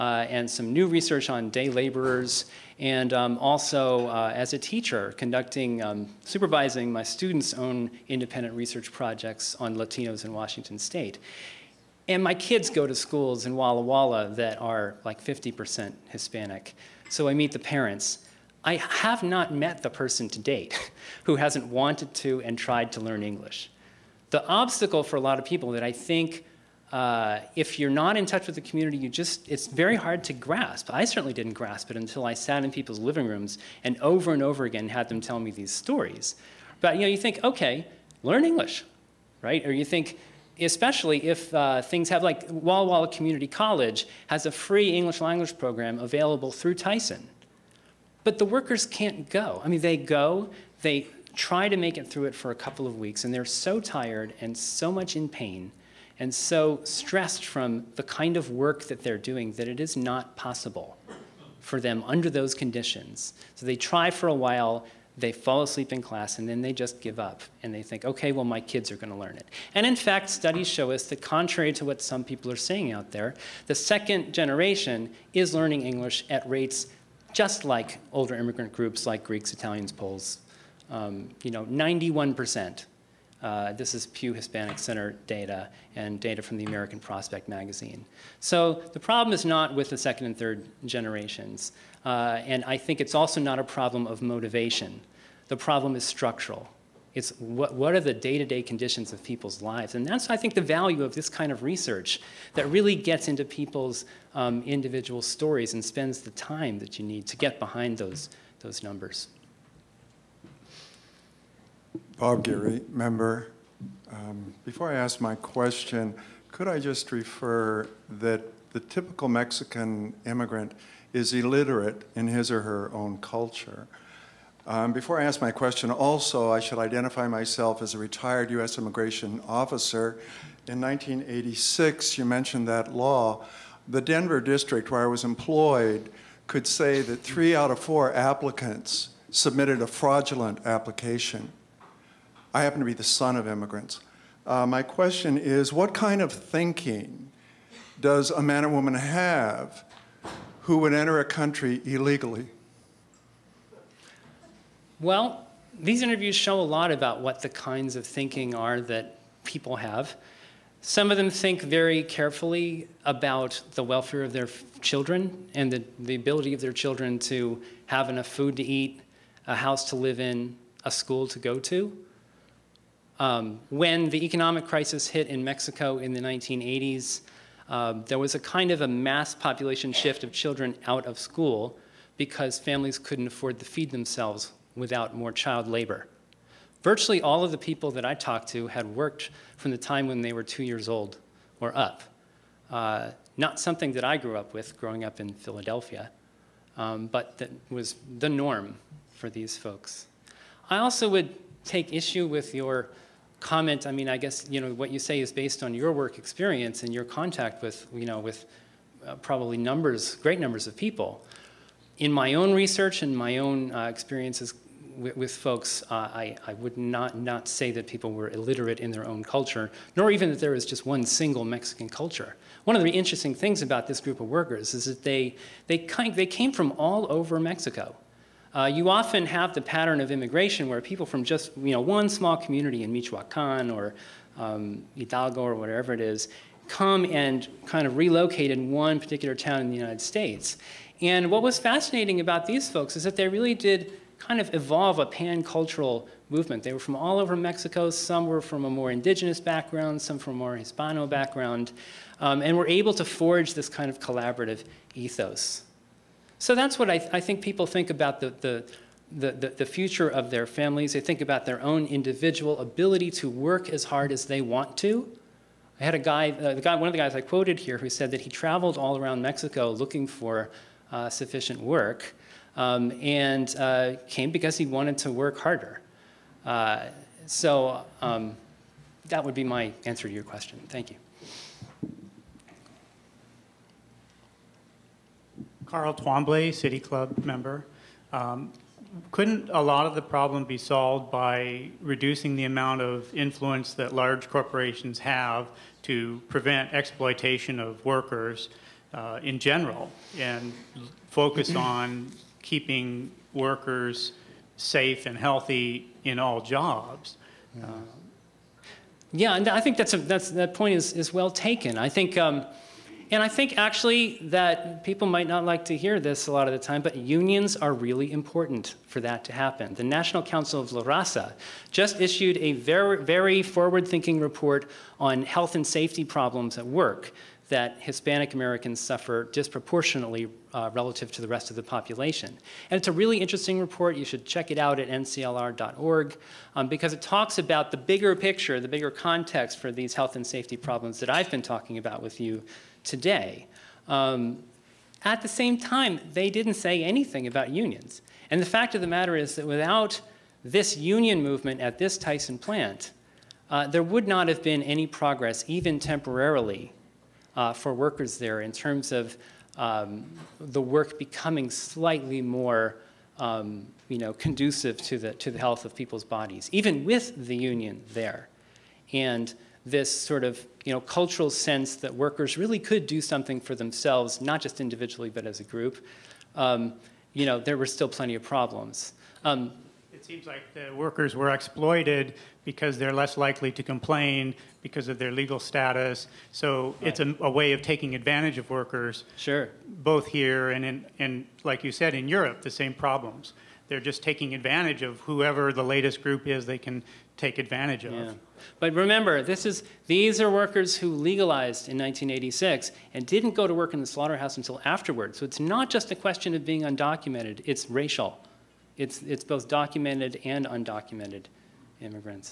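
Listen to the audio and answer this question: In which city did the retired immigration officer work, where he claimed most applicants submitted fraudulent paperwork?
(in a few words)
Denver.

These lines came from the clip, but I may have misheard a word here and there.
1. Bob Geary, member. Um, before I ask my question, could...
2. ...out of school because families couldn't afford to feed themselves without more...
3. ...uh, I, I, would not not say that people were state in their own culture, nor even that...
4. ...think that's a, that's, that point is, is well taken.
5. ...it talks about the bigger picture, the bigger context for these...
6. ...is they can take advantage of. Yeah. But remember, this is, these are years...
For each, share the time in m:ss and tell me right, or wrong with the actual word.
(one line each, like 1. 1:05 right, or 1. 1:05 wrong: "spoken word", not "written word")
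1. 1:52 right
2. 3:00 right
3. 3:35 wrong: "illiterate", not "state"
4. 5:09 right
5. 5:36 right
6. 6:36 wrong: "workers", not "years".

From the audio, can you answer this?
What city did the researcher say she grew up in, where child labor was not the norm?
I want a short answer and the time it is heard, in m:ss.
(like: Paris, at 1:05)
Philadelphia, at 3:15.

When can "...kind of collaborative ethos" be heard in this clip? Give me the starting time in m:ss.
4:13.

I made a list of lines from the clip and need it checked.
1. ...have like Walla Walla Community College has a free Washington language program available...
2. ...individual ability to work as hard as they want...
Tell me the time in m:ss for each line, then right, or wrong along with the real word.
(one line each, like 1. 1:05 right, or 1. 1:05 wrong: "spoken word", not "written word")
1. 0:42 wrong: "English", not "Washington"
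2. 4:21 right.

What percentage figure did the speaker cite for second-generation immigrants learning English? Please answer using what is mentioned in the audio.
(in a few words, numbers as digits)
91%.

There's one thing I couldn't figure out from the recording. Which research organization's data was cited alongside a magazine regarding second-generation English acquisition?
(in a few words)
Pew Hispanic Center.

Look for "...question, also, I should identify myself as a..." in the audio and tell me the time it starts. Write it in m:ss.
2:05.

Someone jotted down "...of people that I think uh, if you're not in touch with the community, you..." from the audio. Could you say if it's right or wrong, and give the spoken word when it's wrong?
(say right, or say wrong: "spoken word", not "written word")
right.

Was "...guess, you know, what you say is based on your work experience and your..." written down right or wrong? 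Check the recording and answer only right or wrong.
right.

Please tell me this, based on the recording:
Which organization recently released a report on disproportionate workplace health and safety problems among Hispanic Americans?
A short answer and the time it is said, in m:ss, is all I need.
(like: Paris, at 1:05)
National Council of La Raza, at 5:19.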